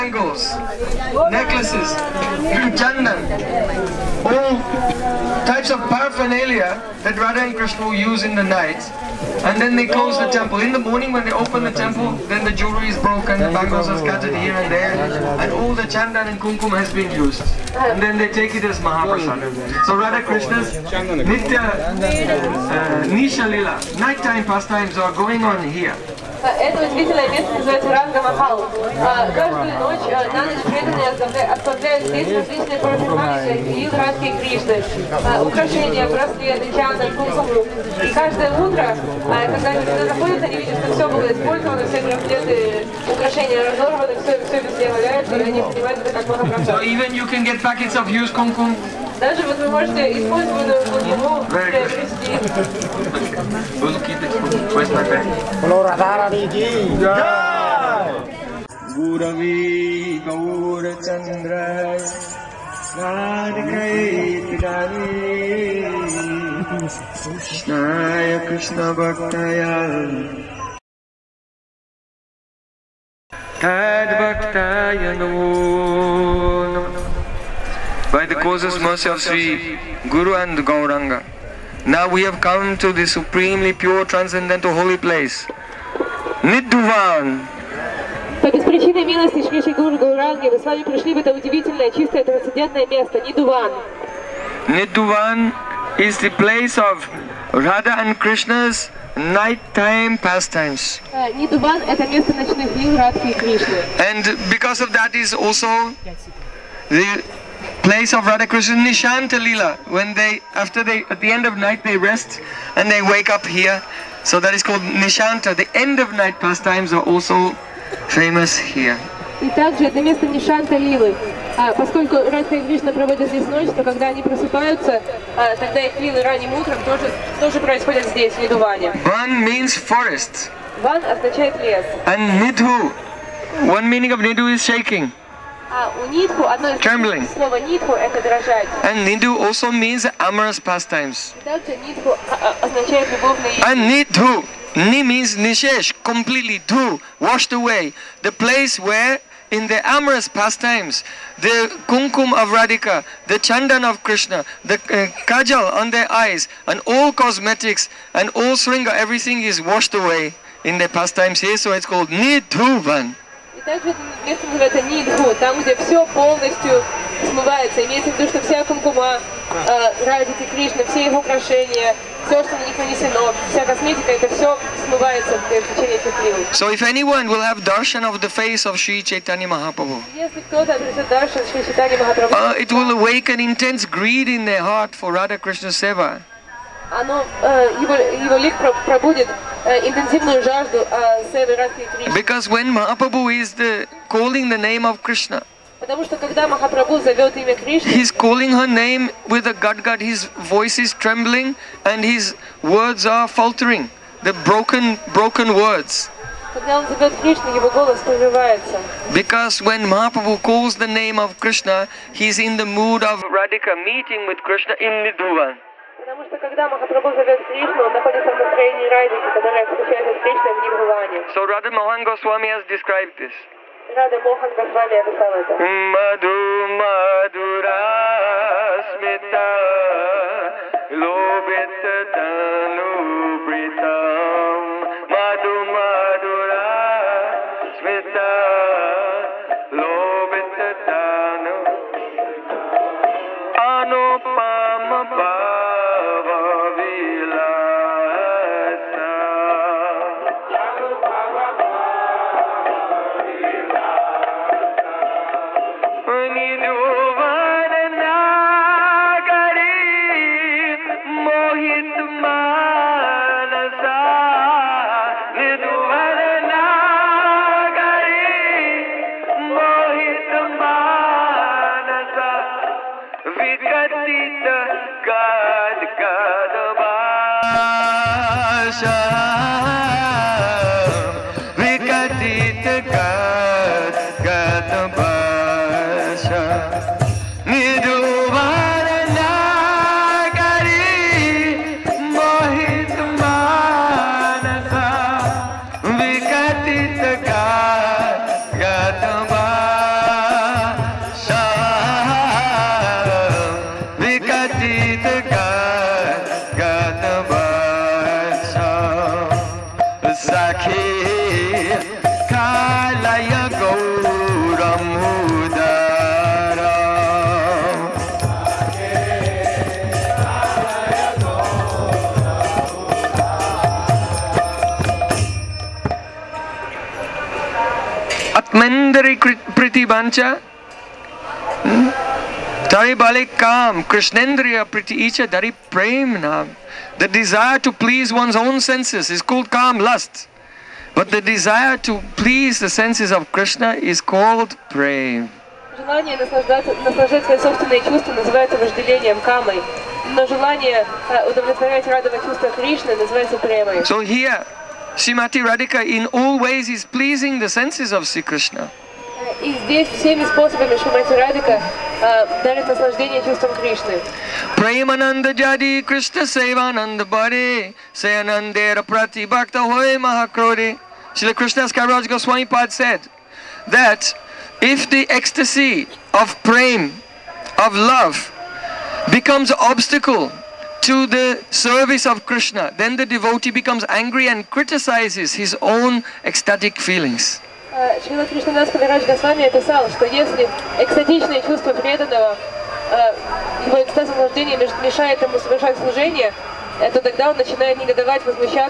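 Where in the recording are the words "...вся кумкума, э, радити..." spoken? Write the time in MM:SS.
02:48.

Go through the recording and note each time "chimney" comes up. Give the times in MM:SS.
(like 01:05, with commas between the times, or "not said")
not said.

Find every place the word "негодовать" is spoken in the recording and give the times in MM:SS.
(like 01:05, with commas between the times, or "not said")
06:37.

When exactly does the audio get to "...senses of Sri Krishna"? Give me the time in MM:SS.
05:57.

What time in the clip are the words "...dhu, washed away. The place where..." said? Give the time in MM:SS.
02:26.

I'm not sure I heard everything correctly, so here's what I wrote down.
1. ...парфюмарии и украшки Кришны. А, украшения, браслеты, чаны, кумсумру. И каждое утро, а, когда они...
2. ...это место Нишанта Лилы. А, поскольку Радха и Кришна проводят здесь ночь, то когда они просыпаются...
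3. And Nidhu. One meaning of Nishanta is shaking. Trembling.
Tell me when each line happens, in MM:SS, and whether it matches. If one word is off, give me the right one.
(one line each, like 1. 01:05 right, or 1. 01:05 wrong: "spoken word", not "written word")
1. 00:32 right
2. 01:59 right
3. 02:12 wrong: "Nidhu", not "Nishanta".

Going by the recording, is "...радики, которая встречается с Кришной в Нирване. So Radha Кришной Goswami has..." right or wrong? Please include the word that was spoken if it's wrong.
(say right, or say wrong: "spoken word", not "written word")
wrong: "Mohan", not "Кришной".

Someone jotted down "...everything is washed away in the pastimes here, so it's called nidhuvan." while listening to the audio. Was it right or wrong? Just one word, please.
right.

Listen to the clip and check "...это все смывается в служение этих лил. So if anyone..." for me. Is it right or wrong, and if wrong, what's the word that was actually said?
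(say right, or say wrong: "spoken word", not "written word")
wrong: "течение", not "служение".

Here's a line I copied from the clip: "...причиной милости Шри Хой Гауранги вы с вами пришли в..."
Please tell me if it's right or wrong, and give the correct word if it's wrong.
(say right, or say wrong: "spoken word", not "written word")
wrong: "Гуру", not "Хой".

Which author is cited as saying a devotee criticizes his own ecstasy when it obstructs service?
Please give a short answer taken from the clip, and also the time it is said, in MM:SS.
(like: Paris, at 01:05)
Krishnadas Kaviraj Goswami, at 06:11.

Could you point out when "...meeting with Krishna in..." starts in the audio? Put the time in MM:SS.
03:33.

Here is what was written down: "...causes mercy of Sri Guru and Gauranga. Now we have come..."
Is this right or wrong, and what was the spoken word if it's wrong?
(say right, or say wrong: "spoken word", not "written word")
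right.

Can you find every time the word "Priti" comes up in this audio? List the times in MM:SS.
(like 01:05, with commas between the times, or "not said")
05:29, 05:34.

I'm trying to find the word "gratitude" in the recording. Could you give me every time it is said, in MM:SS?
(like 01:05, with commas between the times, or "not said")
not said.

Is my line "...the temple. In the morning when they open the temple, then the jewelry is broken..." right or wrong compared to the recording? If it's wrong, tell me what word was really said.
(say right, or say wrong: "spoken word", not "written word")
right.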